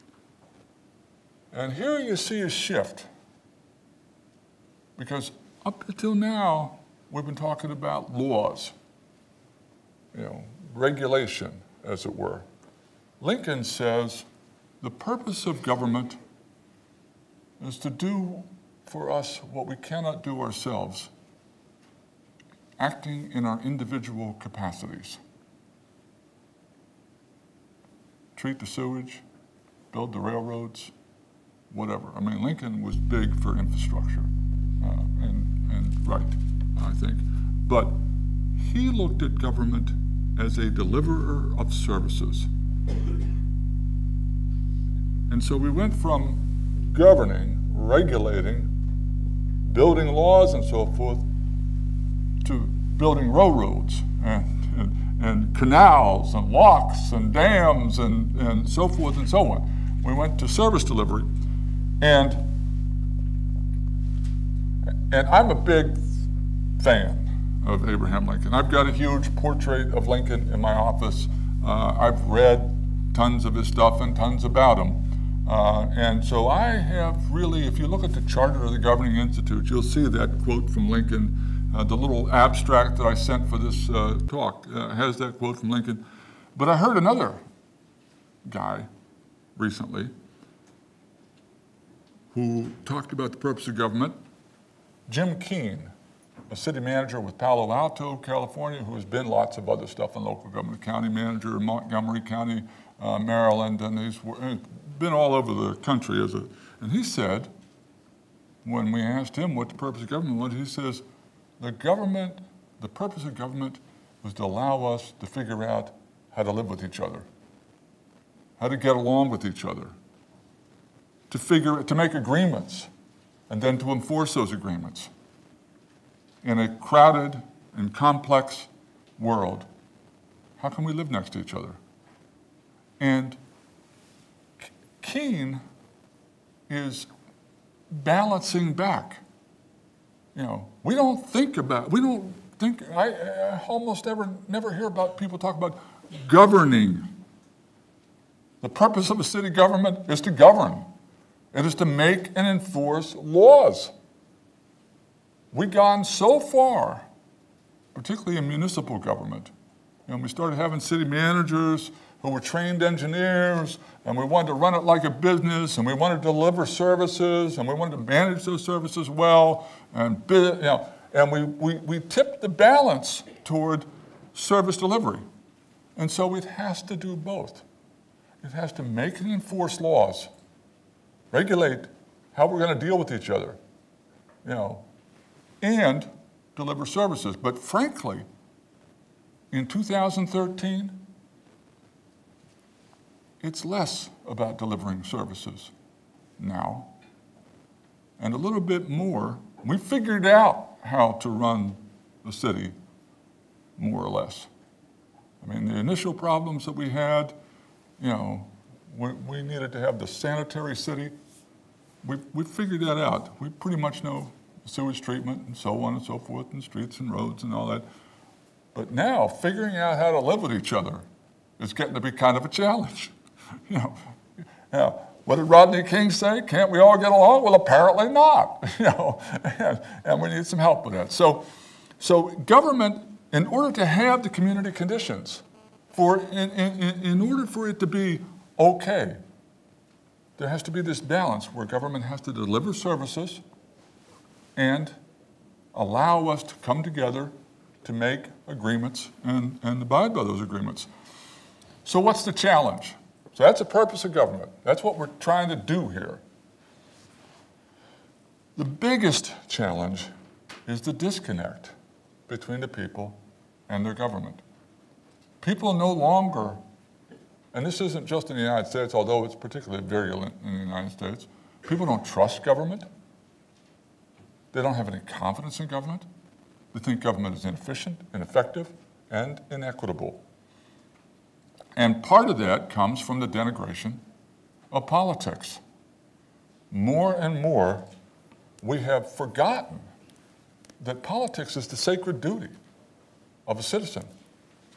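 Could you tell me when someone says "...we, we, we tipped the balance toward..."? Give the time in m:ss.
2:51.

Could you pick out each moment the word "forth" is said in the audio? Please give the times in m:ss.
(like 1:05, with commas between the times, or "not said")
0:50, 0:58, 3:36.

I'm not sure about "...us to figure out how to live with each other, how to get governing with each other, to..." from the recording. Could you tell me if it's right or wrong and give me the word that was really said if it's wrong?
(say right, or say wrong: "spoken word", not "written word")
wrong: "along", not "governing".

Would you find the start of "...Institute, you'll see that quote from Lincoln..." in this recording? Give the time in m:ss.
1:19.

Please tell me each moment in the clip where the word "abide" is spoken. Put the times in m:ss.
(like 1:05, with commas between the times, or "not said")
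4:09.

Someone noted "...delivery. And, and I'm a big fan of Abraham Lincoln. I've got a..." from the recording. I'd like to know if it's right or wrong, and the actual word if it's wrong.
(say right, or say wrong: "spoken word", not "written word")
right.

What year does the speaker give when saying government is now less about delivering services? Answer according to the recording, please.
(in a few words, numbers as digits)
2013.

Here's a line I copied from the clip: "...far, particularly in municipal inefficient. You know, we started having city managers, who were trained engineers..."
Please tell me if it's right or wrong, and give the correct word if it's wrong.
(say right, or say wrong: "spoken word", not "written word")
wrong: "government", not "inefficient".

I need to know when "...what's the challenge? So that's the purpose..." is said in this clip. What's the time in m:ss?
4:11.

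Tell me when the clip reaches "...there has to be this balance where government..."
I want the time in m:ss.
4:00.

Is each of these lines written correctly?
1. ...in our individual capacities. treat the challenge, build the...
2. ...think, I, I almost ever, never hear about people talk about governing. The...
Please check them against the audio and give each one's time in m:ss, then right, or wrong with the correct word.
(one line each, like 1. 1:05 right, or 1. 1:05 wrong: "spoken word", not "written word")
1. 0:23 wrong: "sewage", not "challenge"
2. 2:22 right.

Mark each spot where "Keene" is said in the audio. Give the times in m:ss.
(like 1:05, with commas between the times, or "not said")
1:35, 2:15.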